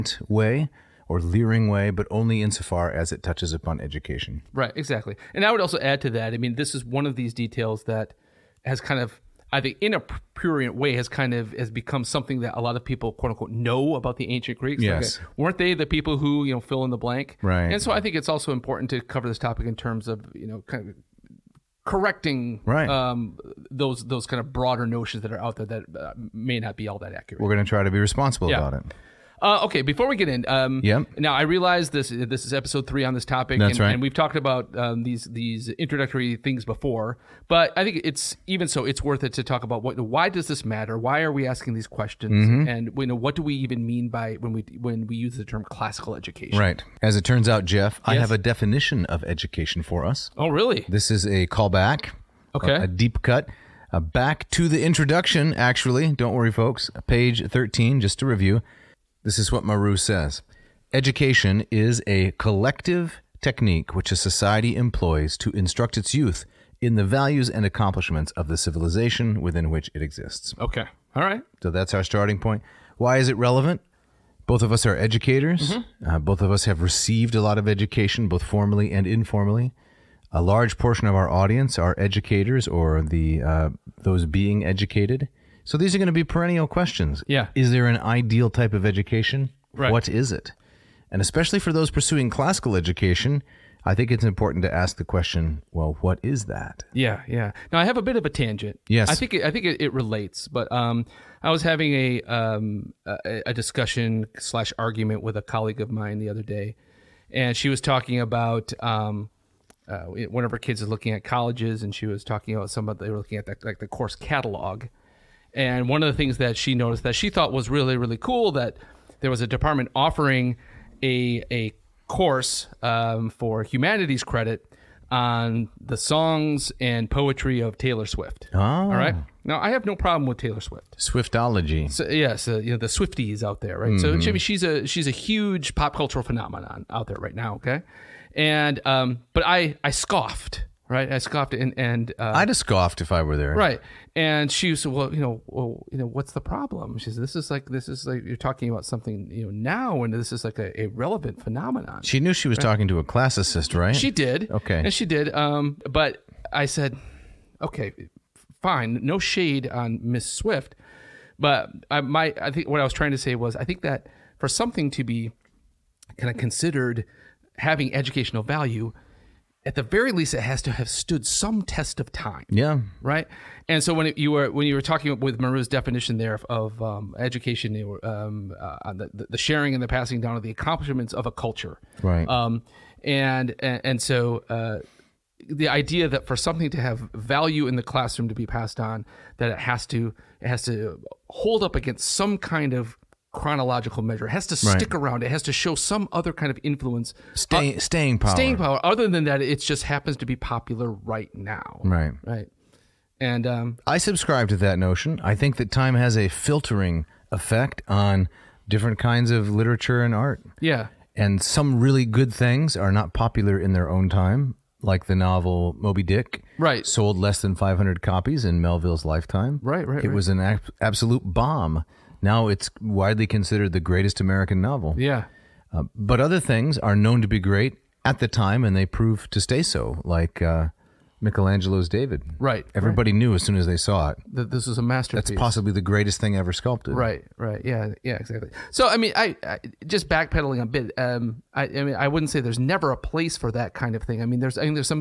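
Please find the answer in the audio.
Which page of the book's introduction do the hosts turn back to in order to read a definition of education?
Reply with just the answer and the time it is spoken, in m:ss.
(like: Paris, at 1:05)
13, at 0:57.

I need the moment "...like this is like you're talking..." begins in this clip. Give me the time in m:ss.
2:27.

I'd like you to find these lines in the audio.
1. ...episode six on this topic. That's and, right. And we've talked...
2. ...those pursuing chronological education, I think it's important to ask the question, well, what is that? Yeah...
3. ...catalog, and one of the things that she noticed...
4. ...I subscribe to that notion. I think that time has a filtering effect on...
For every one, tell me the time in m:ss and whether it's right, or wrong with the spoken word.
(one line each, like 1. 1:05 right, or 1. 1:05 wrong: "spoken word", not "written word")
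1. 0:32 wrong: "three", not "six"
2. 1:31 wrong: "classical", not "chronological"
3. 1:54 right
4. 3:23 right.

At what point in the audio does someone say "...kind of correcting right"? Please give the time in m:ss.
0:20.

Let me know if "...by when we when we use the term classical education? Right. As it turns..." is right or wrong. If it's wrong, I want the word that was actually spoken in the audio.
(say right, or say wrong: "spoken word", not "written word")
right.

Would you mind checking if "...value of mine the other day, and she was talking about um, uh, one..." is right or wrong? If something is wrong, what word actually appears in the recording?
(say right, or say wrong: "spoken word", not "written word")
wrong: "colleague", not "value".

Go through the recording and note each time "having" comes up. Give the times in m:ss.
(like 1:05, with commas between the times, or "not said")
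1:41, 2:47.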